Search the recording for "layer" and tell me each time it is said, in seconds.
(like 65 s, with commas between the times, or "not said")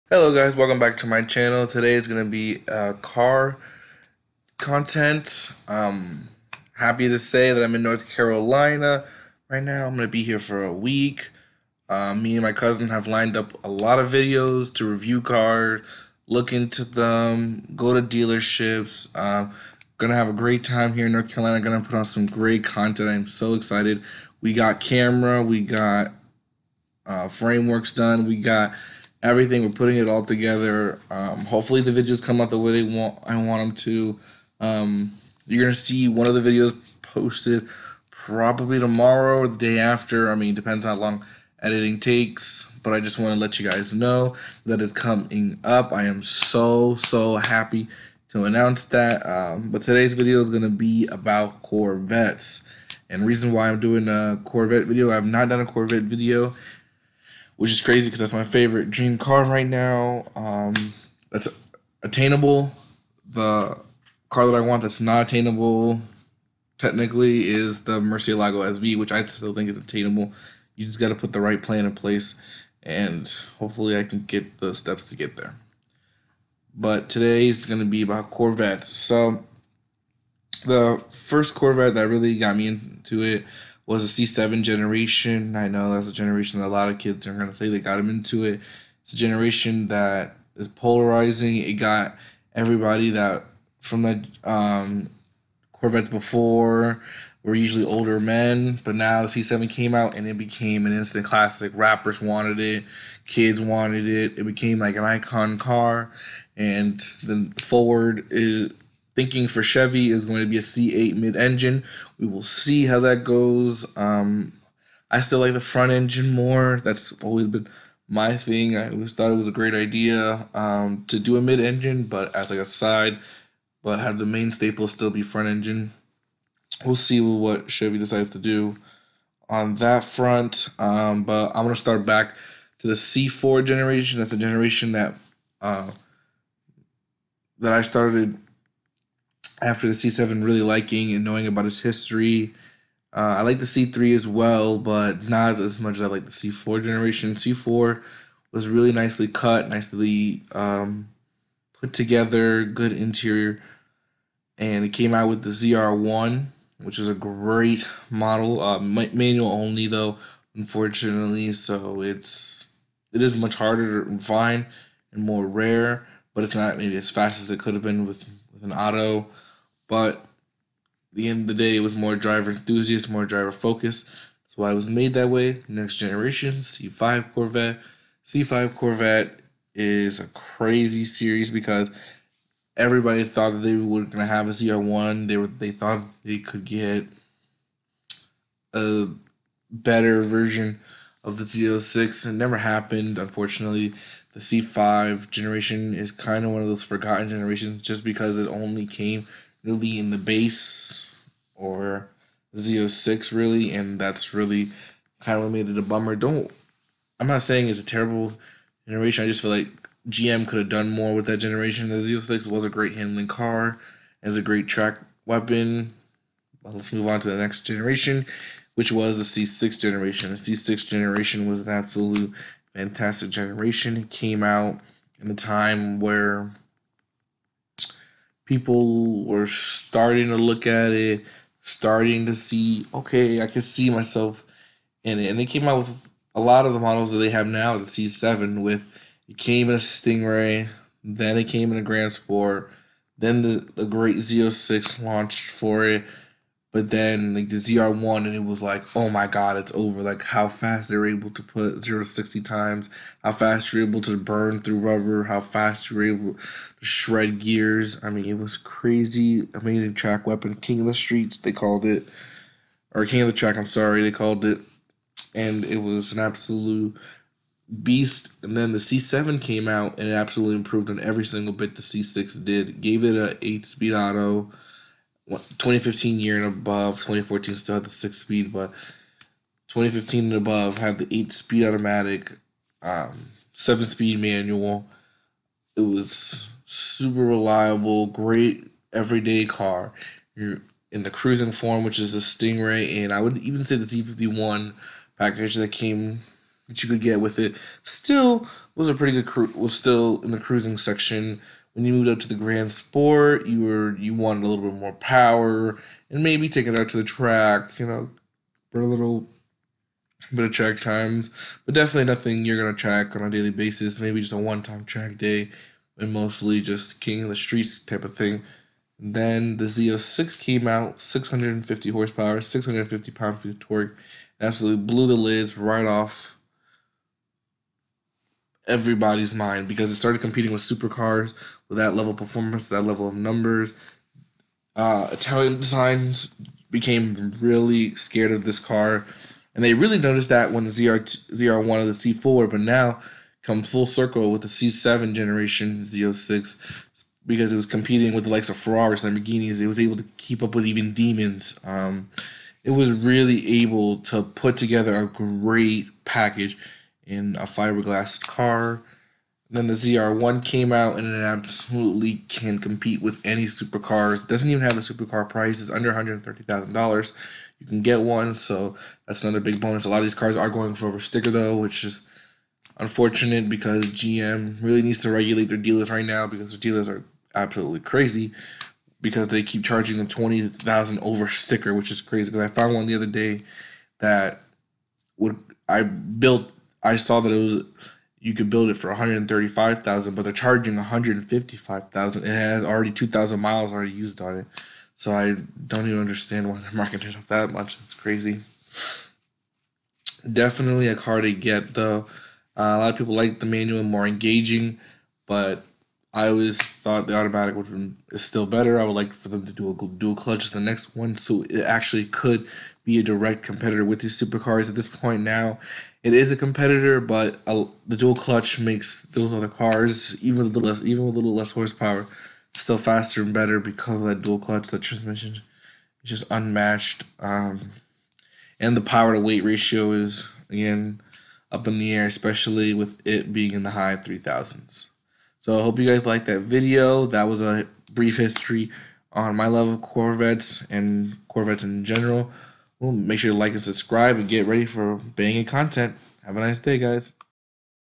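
not said.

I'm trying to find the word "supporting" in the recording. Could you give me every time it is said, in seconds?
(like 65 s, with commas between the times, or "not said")
not said.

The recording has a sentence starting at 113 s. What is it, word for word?
Um, I still like the front engine more.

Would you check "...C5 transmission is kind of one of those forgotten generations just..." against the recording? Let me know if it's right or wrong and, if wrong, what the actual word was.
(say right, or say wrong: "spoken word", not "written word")
wrong: "generation", not "transmission".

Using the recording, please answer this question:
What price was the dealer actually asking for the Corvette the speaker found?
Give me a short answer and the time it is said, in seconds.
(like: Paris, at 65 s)
$155,000, at 390 s.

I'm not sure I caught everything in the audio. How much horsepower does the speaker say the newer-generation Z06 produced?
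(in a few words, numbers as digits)
650.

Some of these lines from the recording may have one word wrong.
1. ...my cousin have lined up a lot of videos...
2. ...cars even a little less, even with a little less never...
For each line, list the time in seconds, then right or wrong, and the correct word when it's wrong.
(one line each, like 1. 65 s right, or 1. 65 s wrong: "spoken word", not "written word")
1. 12 s right
2. 419 s wrong: "horsepower", not "never".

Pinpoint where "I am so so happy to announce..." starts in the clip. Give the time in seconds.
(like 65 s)
45 s.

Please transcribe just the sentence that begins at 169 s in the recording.
But the end of the day, it was more driver enthusiast, more driver focus.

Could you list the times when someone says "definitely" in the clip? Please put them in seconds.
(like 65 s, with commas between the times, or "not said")
311 s, 400 s.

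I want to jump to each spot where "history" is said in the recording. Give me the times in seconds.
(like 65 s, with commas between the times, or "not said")
141 s, 438 s.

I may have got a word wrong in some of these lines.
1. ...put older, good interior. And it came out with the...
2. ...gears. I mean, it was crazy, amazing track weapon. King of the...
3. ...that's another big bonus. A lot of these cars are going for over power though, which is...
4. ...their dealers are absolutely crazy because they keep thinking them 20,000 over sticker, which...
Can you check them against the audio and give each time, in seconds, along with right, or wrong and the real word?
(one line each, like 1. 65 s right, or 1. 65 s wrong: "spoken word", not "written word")
1. 151 s wrong: "together", not "older"
2. 257 s right
3. 369 s wrong: "sticker", not "power"
4. 376 s wrong: "charging", not "thinking".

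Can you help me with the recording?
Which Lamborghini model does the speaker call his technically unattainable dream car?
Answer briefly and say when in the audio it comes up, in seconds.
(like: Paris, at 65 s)
Murcielago SV, at 67 s.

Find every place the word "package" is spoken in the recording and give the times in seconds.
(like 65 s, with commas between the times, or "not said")
295 s, 356 s.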